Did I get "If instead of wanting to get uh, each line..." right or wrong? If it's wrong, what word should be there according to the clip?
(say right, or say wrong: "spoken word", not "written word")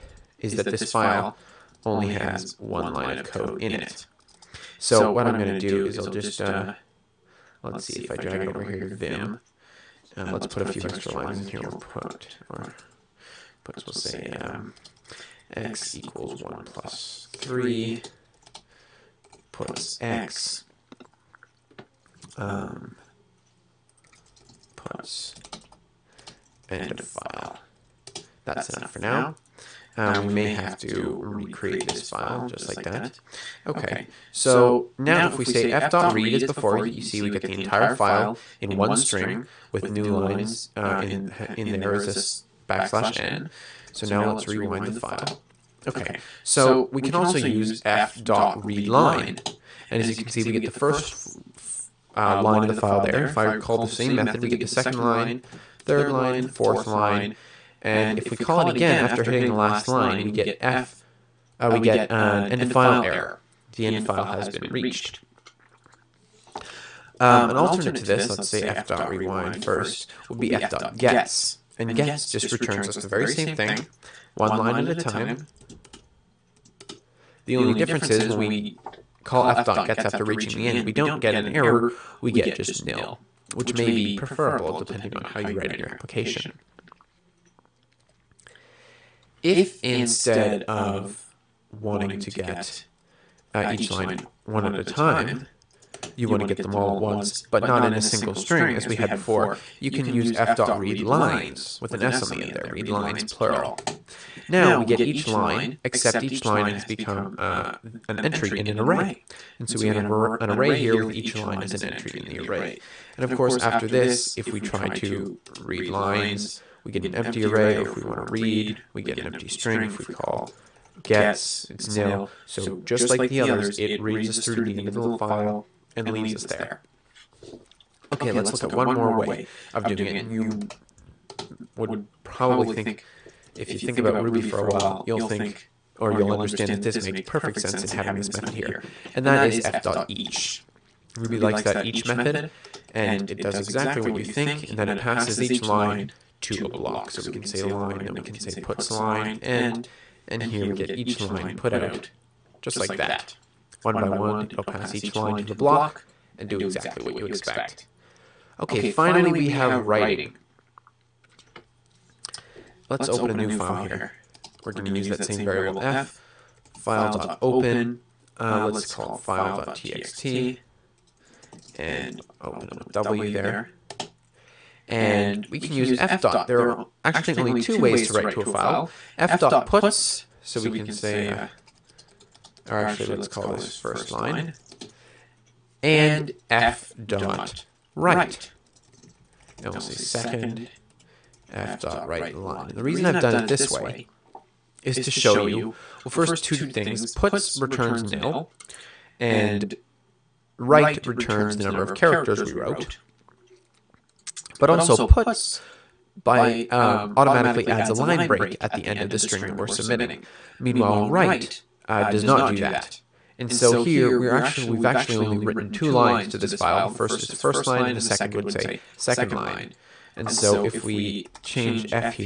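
right.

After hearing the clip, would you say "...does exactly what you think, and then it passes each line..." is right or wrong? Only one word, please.
right.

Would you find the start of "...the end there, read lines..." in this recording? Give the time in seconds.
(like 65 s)
102 s.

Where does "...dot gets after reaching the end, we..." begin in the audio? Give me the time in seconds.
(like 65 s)
79 s.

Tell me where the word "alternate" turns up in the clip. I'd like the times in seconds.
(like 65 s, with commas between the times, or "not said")
67 s.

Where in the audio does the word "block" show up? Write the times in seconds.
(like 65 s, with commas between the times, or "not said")
146 s, 155 s.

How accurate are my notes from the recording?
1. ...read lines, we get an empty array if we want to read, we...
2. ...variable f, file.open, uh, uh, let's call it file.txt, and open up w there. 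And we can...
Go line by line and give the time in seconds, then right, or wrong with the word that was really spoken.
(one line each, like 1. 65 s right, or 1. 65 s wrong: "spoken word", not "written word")
1. 115 s right
2. 165 s right.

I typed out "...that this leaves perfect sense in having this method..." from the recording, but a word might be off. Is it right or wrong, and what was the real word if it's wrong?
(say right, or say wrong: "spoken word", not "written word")
wrong: "makes", not "leaves".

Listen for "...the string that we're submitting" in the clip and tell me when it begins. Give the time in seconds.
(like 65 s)
209 s.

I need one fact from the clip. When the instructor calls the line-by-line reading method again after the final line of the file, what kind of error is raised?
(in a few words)
end file error.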